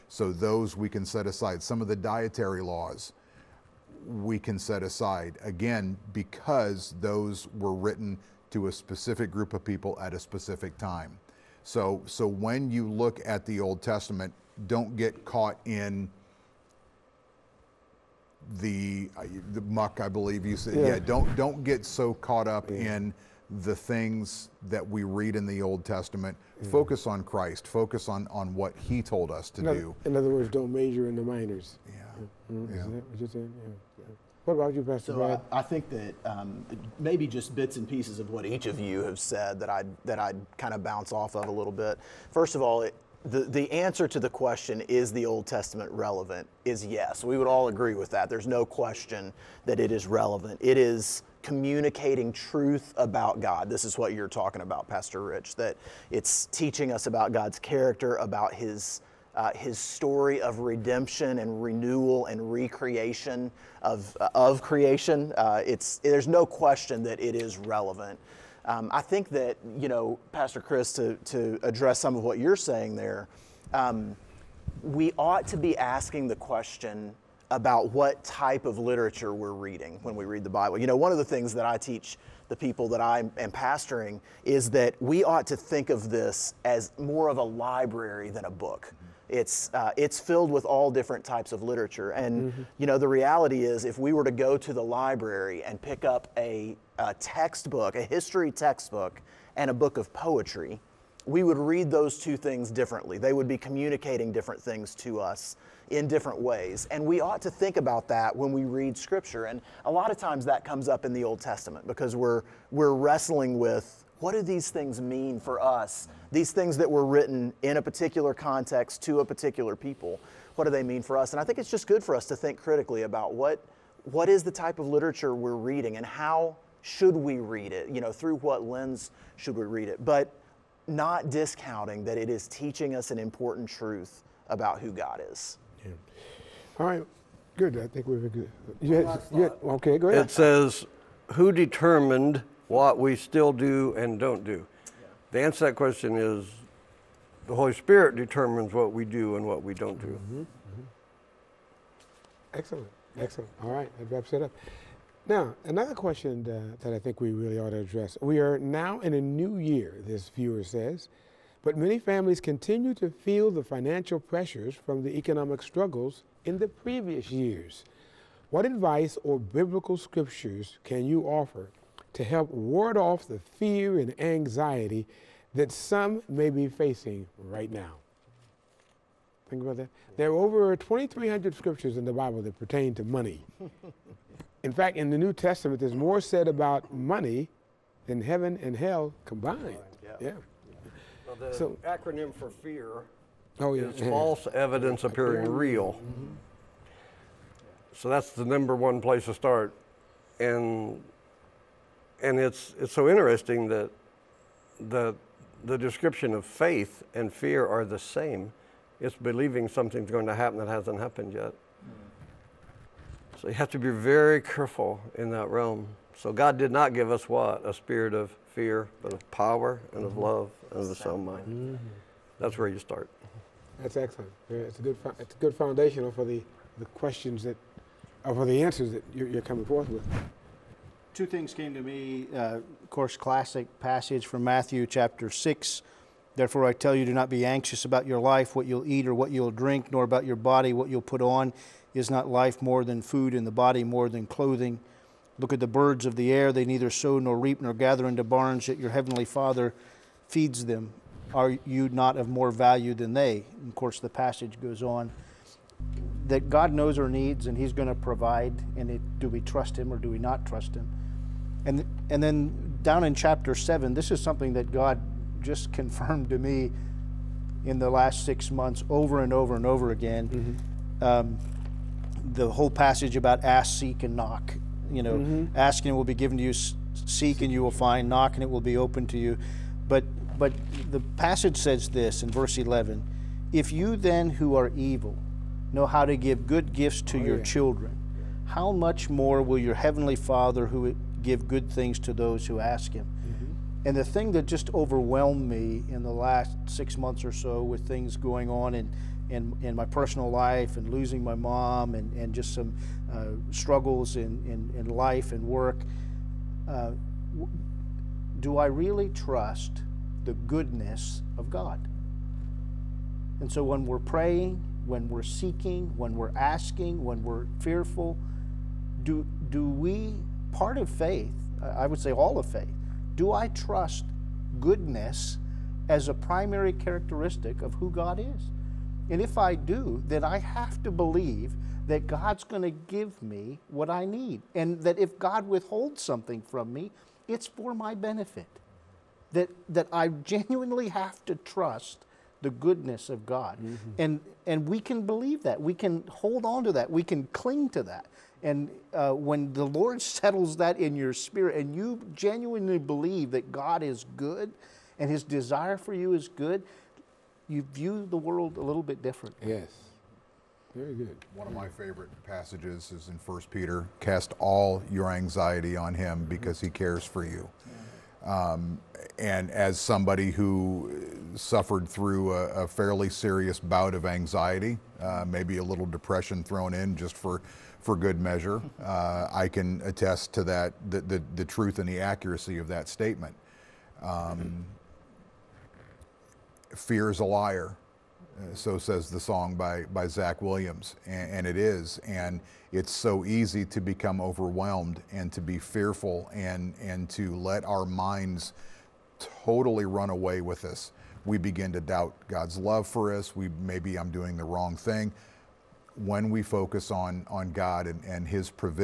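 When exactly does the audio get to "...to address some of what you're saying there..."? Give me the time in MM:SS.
01:11.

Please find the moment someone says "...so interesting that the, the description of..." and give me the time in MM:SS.
03:22.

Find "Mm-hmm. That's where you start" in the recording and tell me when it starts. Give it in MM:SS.
03:41.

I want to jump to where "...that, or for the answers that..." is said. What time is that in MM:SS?
03:47.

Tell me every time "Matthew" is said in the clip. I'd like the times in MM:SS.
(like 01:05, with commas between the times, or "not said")
03:54.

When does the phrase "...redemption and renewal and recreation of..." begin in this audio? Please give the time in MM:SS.
01:00.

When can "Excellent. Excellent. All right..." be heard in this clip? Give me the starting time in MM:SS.
02:32.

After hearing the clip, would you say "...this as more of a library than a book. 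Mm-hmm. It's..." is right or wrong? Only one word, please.
right.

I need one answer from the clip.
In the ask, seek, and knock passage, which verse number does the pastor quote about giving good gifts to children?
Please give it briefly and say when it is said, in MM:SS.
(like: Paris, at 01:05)
Verse 11, at 04:42.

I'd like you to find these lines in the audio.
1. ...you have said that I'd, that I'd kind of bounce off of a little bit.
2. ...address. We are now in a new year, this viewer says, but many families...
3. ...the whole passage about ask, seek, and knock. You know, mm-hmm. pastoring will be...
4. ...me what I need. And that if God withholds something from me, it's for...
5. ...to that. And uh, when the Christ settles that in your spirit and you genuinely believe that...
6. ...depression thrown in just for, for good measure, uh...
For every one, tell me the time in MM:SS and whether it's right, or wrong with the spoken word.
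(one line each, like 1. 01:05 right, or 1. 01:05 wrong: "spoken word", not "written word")
1. 00:38 right
2. 02:37 right
3. 04:32 wrong: "asking", not "pastoring"
4. 05:33 right
5. 05:47 wrong: "Lord", not "Christ"
6. 06:15 right.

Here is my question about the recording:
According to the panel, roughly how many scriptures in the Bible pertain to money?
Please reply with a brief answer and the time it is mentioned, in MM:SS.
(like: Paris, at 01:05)
Over 2,300, at 03:00.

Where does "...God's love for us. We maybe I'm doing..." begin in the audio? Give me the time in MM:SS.
06:42.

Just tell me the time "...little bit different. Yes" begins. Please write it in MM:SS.
05:58.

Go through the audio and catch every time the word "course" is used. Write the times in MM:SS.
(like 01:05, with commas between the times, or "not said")
03:52, 04:13.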